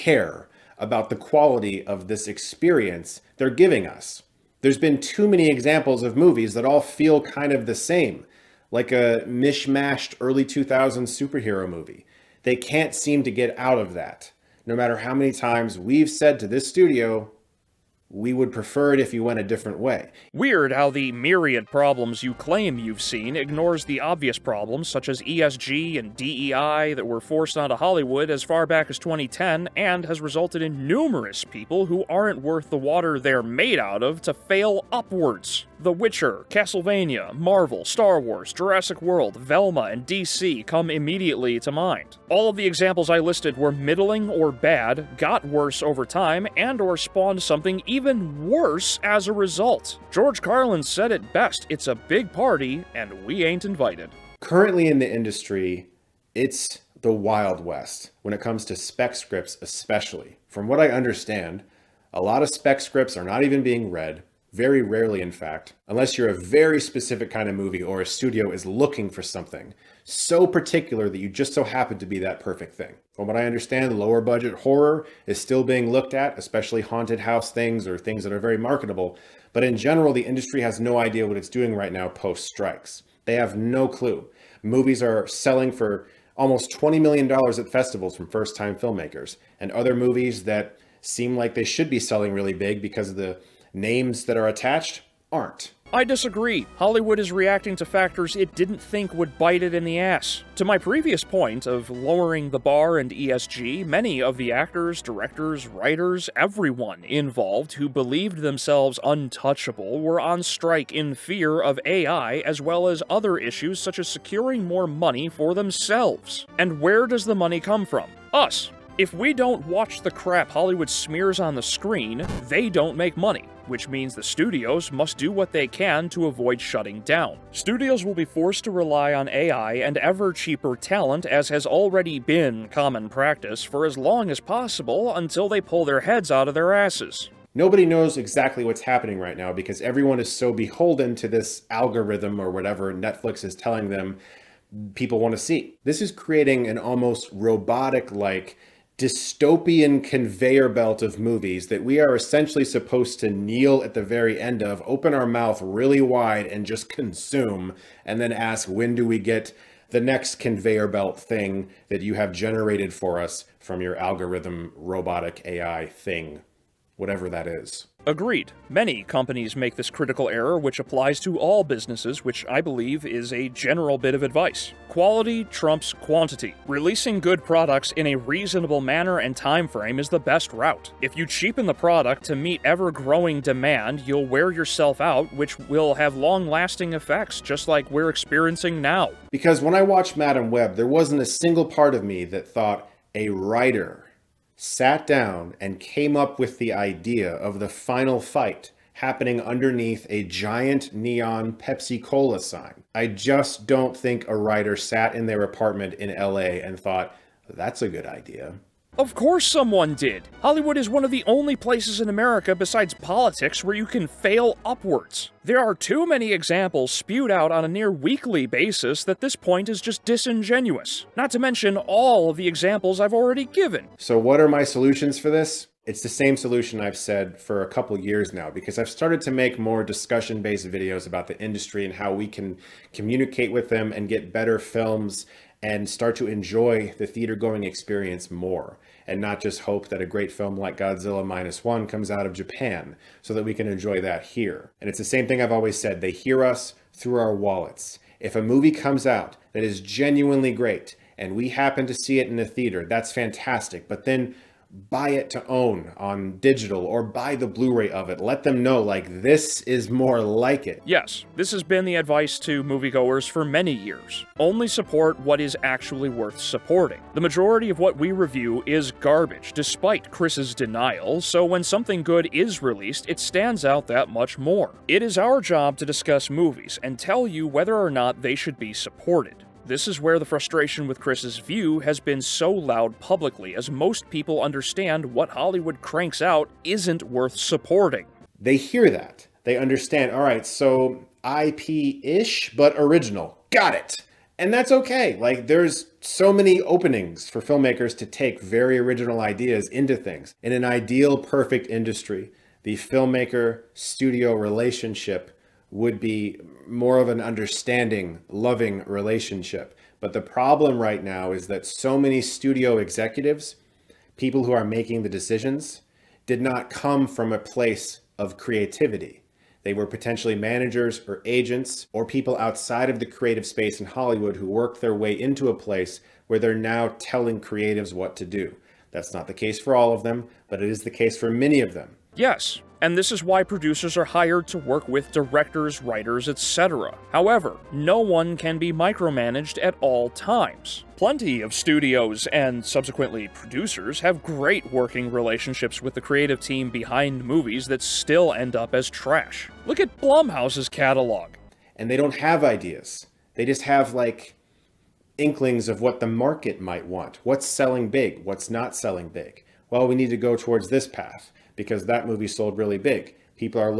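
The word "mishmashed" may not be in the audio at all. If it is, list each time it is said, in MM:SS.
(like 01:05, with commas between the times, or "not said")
00:09.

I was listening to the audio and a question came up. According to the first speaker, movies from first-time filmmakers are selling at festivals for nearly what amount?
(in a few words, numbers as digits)
$20 million.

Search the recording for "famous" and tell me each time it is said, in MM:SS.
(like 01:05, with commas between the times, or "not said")
not said.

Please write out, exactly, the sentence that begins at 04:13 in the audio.
But then buy it to own on digital or buy the Blu-ray of it.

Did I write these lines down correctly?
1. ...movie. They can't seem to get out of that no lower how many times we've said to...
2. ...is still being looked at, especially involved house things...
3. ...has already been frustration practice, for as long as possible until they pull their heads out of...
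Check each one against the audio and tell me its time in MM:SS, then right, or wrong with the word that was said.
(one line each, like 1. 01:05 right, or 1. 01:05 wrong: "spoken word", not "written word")
1. 00:11 wrong: "matter", not "lower"
2. 01:15 wrong: "haunted", not "involved"
3. 02:11 wrong: "common", not "frustration".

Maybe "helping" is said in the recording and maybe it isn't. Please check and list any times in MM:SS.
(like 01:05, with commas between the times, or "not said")
not said.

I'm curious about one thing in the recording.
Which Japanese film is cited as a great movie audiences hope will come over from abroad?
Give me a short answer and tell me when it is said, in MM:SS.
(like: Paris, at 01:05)
Godzilla Minus One, at 04:00.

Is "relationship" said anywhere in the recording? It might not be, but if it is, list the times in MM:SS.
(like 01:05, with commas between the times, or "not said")
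05:04, 05:08, 05:45.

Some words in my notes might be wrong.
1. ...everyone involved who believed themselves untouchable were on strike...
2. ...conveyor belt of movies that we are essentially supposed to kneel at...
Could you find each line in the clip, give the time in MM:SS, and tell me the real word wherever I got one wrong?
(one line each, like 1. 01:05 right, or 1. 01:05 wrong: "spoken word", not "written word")
1. 01:46 right
2. 02:30 right.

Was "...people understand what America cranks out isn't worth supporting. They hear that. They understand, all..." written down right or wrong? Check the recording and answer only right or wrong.
wrong.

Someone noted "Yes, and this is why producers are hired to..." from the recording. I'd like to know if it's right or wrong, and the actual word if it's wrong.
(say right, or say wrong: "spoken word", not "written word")
right.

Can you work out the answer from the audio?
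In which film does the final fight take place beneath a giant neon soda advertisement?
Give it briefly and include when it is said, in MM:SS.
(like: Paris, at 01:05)
Madame Web, at 03:10.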